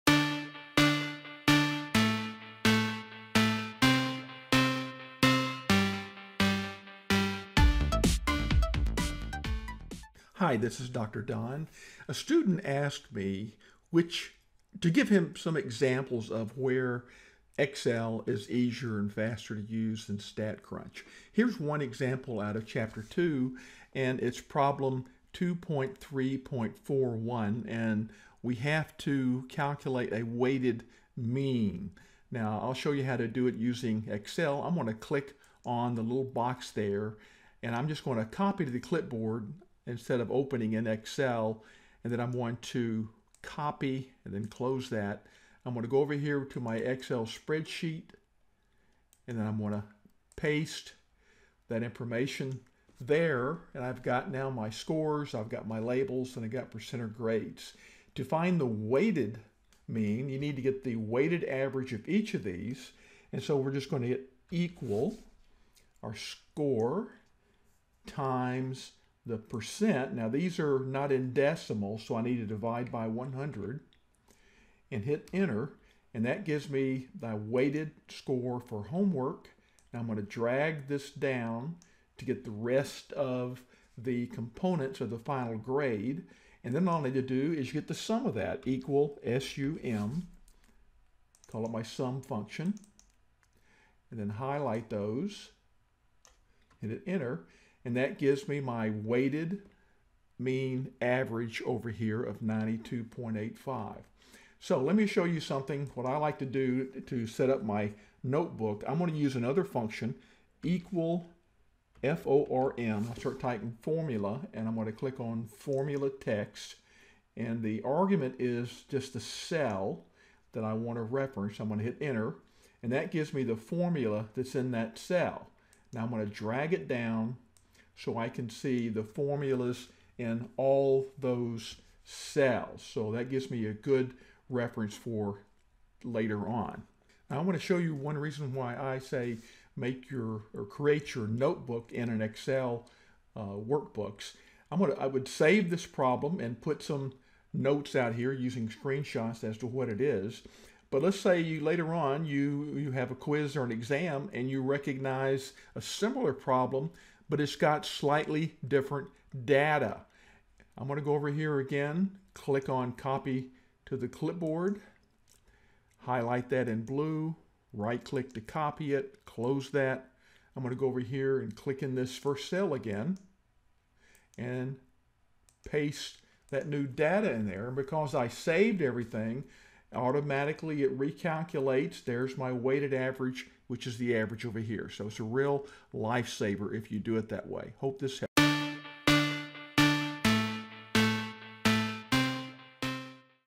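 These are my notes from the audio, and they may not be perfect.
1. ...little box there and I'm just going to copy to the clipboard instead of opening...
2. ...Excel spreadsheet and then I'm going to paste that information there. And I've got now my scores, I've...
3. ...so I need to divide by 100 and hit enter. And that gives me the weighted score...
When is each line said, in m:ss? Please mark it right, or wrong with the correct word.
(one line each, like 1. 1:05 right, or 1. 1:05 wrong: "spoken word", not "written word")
1. 0:36 right
2. 0:46 right
3. 1:12 right.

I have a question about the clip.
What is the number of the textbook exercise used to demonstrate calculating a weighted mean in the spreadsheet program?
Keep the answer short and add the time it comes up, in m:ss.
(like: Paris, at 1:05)
2.3.41, at 0:25.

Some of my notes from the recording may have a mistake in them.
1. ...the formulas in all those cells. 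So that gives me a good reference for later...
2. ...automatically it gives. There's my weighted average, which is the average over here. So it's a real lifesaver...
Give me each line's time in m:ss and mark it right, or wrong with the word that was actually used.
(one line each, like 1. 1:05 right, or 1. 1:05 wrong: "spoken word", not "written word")
1. 2:08 right
2. 2:59 wrong: "recalculates", not "gives".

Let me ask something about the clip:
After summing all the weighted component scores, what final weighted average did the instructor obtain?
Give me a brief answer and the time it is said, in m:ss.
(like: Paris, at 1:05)
92.85, at 1:42.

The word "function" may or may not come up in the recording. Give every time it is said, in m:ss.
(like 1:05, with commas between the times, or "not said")
1:32, 1:49.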